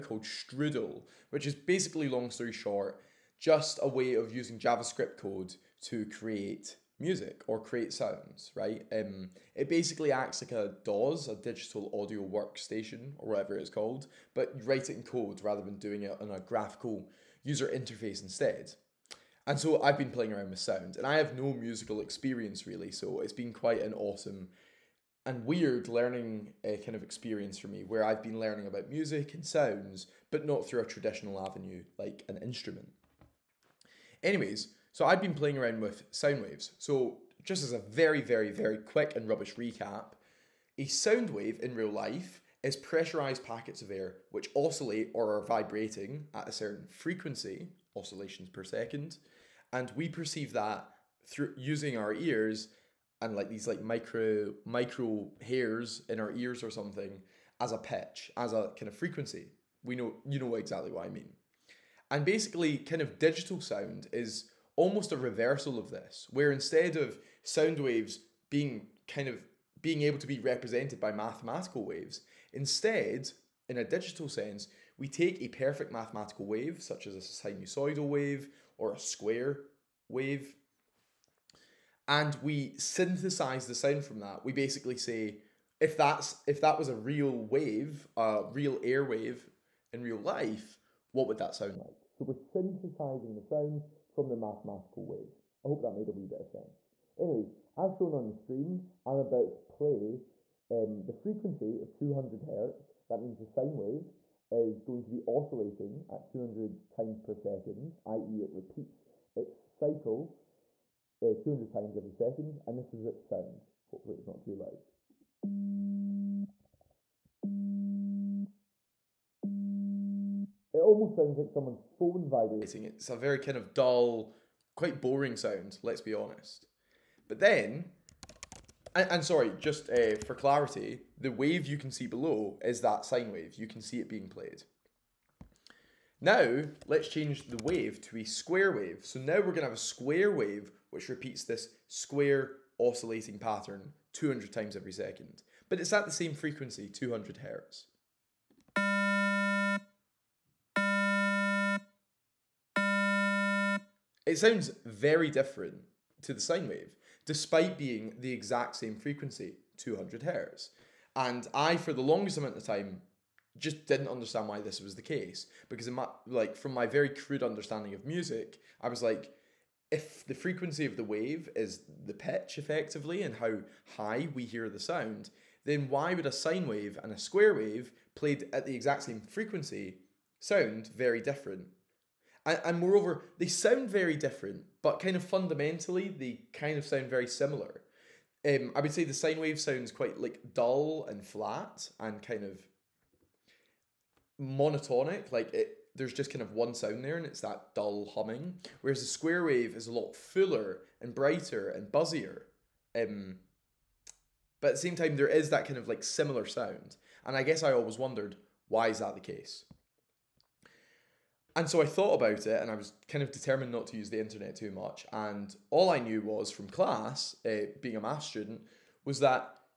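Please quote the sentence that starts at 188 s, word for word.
Um, I would say the sine wave sounds quite like dull and flat and kind of monotonic.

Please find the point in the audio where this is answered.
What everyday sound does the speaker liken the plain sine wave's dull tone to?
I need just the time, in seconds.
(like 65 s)
121 s.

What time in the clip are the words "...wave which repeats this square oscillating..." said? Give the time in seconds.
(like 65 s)
140 s.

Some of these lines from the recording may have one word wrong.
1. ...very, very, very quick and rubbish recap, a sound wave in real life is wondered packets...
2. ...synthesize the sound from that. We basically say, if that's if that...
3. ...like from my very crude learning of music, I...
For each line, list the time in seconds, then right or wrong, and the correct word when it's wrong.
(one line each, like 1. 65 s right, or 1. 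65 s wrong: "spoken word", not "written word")
1. 37 s wrong: "pressurized", not "wondered"
2. 82 s right
3. 166 s wrong: "understanding", not "learning".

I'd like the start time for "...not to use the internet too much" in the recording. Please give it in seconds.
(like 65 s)
213 s.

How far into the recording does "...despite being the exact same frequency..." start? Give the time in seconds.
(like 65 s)
157 s.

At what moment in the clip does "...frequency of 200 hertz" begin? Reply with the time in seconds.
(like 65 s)
101 s.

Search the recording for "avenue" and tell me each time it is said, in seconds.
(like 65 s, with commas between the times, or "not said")
31 s.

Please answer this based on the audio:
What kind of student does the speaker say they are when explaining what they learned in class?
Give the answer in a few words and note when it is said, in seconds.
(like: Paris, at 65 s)
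math student, at 218 s.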